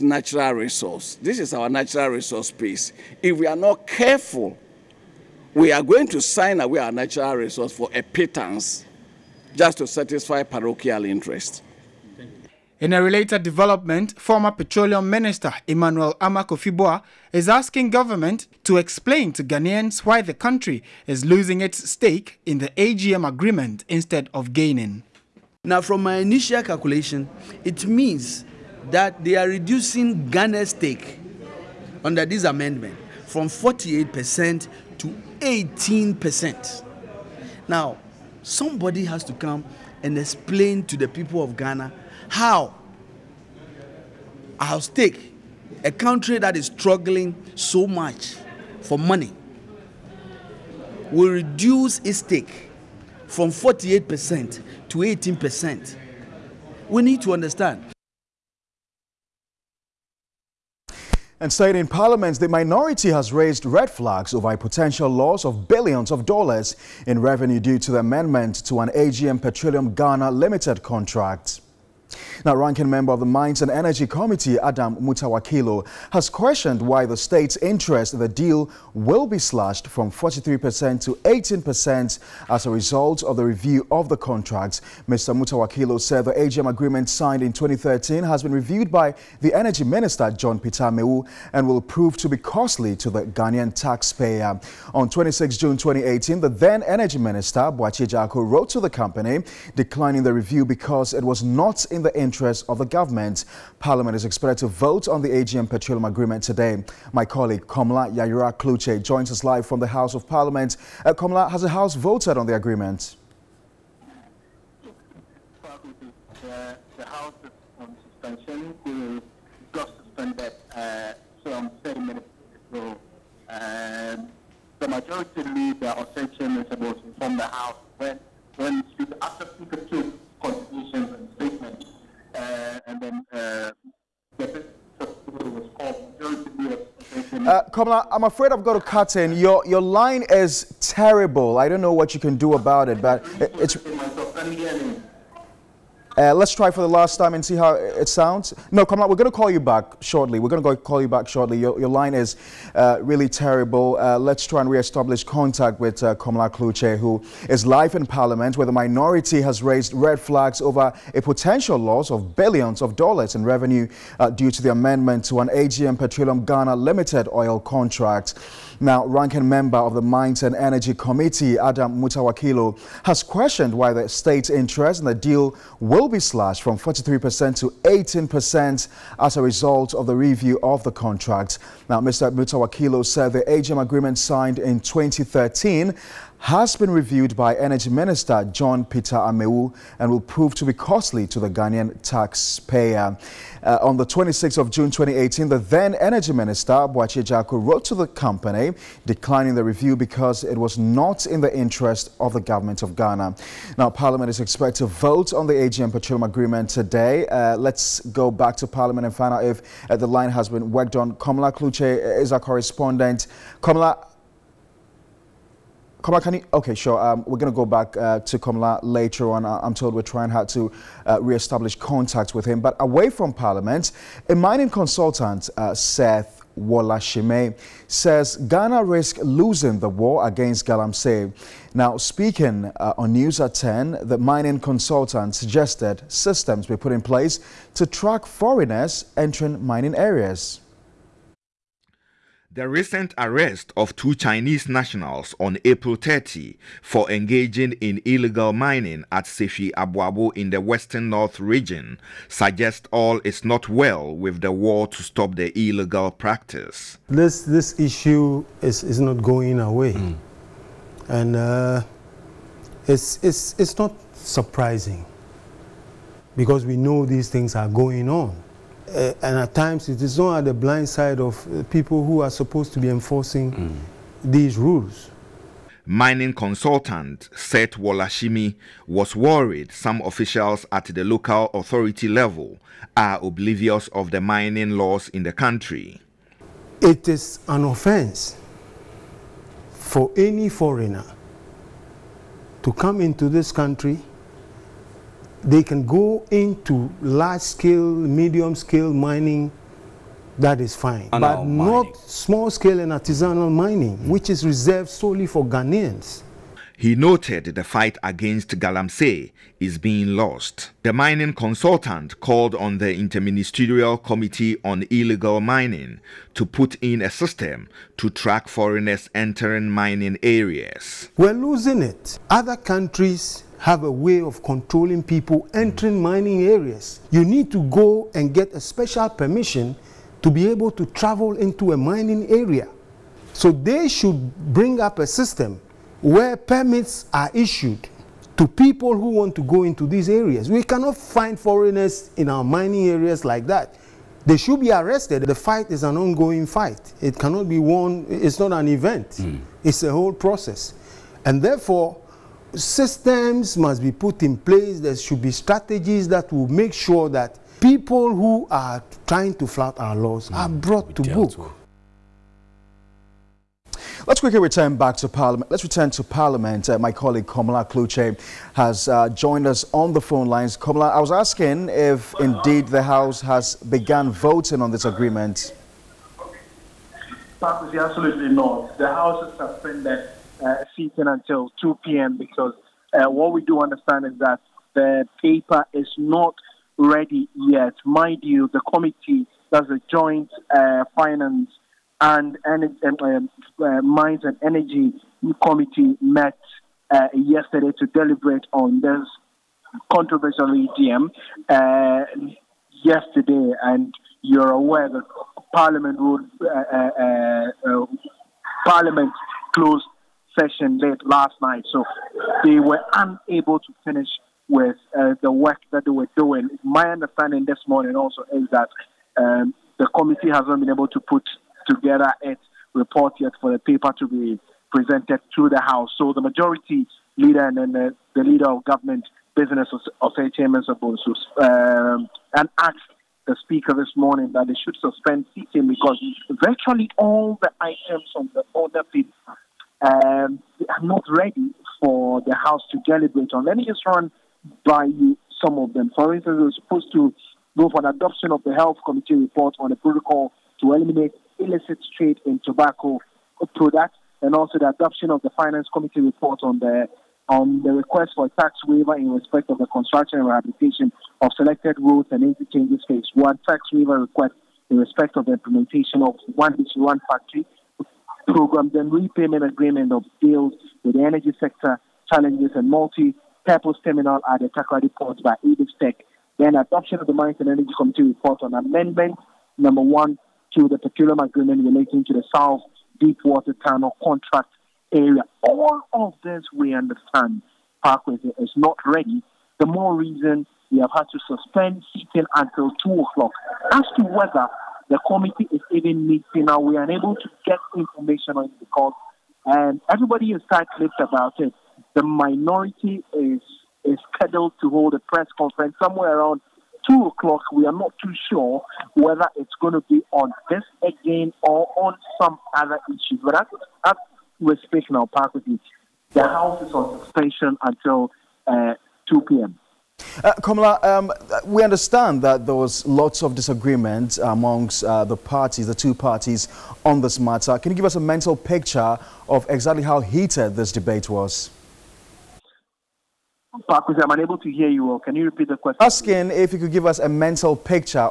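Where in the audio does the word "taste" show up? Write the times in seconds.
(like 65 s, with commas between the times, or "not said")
not said.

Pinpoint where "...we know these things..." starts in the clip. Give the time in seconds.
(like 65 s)
266 s.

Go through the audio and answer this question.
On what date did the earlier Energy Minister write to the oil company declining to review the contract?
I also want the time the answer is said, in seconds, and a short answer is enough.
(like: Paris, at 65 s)
26 June 2018, at 94 s.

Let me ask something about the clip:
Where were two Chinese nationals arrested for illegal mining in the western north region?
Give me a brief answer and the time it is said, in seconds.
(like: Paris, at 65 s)
Sefwi Abuabo, at 249 s.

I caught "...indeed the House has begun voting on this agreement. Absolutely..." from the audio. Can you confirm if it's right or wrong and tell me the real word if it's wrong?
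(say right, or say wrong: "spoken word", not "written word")
right.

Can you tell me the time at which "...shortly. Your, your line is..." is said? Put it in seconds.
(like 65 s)
151 s.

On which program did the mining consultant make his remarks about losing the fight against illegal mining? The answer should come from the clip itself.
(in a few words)
News at 10.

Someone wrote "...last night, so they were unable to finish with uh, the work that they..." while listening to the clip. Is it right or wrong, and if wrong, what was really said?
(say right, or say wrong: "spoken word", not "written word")
right.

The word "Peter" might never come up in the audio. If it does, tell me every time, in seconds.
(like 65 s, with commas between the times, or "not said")
90 s, 188 s.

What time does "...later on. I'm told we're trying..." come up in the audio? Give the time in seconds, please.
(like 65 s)
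218 s.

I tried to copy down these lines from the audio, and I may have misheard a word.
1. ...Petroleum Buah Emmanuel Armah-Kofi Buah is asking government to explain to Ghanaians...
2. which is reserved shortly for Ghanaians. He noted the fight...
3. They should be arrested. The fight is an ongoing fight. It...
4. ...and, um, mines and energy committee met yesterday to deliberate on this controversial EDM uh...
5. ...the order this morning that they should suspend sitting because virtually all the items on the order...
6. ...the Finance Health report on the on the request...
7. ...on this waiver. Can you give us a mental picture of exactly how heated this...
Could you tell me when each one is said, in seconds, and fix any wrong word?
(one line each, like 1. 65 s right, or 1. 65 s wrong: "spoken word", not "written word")
1. 14 s wrong: "Minister", not "Buah"
2. 304 s wrong: "solely", not "shortly"
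3. 344 s right
4. 392 s right
5. 433 s wrong: "speaker", not "order"
6. 455 s wrong: "Committee", not "Health"
7. 526 s wrong: "matter", not "waiver".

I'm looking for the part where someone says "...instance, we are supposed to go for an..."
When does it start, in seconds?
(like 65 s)
446 s.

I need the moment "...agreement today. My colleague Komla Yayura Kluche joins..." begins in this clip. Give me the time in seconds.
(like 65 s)
106 s.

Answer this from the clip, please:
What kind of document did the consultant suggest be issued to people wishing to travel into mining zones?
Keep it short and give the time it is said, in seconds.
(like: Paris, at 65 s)
Permits, at 336 s.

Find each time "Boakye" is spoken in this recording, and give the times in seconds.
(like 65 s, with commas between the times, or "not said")
97 s, 196 s.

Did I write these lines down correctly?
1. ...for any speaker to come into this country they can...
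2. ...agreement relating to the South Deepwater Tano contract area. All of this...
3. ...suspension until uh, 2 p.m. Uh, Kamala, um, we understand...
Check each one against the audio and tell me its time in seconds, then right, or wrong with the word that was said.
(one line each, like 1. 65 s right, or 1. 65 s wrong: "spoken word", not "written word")
1. 289 s wrong: "foreigner", not "speaker"
2. 481 s right
3. 517 s right.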